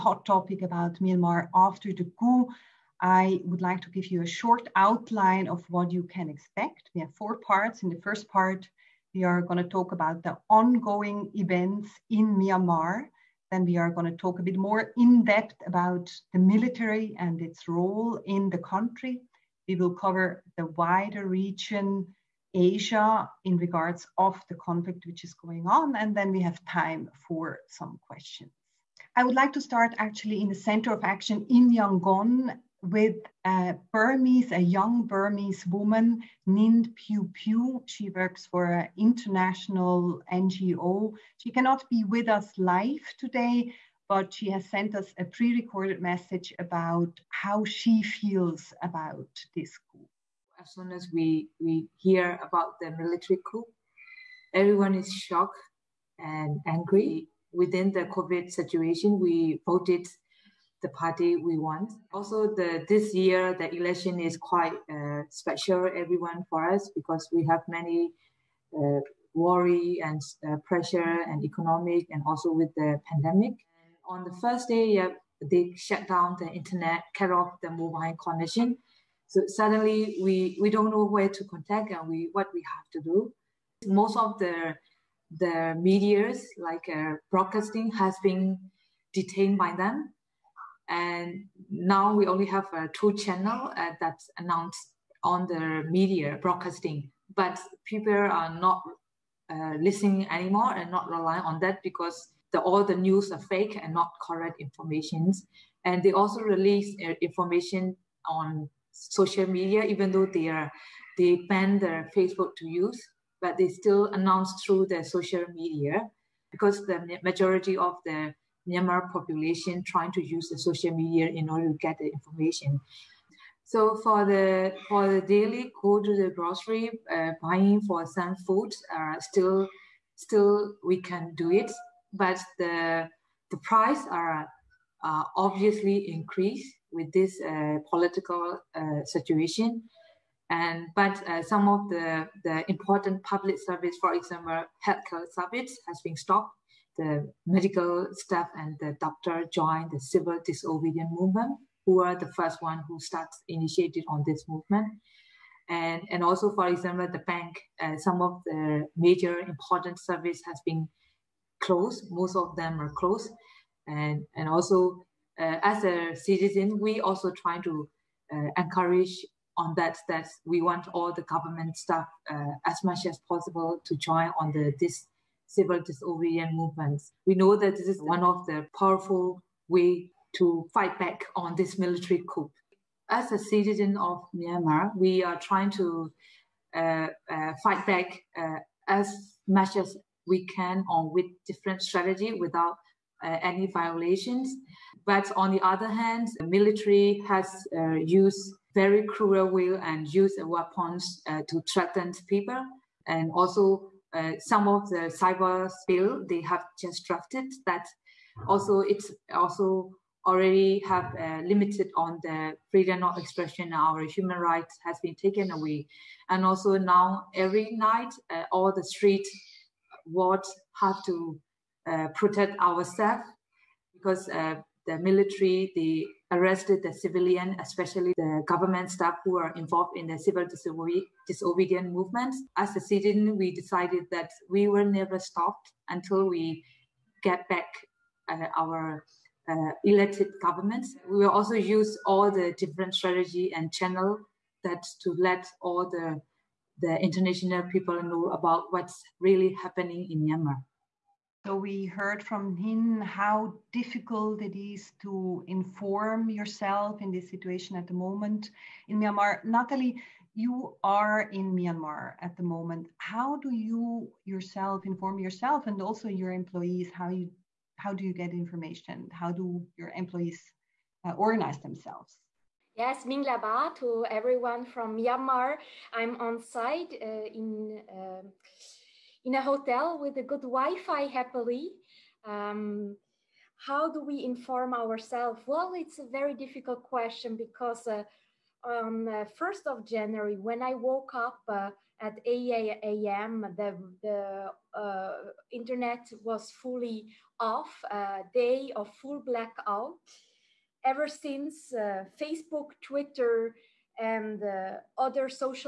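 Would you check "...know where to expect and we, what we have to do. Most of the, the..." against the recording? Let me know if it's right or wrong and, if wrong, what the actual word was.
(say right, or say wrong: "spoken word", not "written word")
wrong: "contact", not "expect".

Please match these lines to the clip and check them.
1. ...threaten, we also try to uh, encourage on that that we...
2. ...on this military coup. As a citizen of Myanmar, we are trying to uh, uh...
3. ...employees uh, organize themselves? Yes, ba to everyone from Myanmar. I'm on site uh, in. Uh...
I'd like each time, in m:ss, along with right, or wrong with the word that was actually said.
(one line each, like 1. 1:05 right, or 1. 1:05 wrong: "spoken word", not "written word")
1. 2:46 wrong: "citizen", not "threaten"
2. 3:01 right
3. 4:29 right.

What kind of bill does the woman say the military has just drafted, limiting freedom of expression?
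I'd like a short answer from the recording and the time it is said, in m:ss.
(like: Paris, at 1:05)
Cyber bill, at 3:25.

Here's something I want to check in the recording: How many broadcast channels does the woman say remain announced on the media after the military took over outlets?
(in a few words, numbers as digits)
2.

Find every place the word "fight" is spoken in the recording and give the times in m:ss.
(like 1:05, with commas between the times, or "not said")
3:00, 3:07.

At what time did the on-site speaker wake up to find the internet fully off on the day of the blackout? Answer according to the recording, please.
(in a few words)
8 a.m.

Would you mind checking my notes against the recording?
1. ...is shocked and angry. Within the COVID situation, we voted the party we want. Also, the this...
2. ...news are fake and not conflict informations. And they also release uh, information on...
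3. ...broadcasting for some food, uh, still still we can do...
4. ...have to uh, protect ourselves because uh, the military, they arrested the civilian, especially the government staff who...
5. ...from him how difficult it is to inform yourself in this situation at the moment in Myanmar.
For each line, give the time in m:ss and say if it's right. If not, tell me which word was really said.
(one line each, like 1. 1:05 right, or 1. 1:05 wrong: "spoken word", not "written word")
1. 0:54 right
2. 1:42 wrong: "correct", not "conflict"
3. 2:07 wrong: "buying", not "broadcasting"
4. 3:40 right
5. 4:12 right.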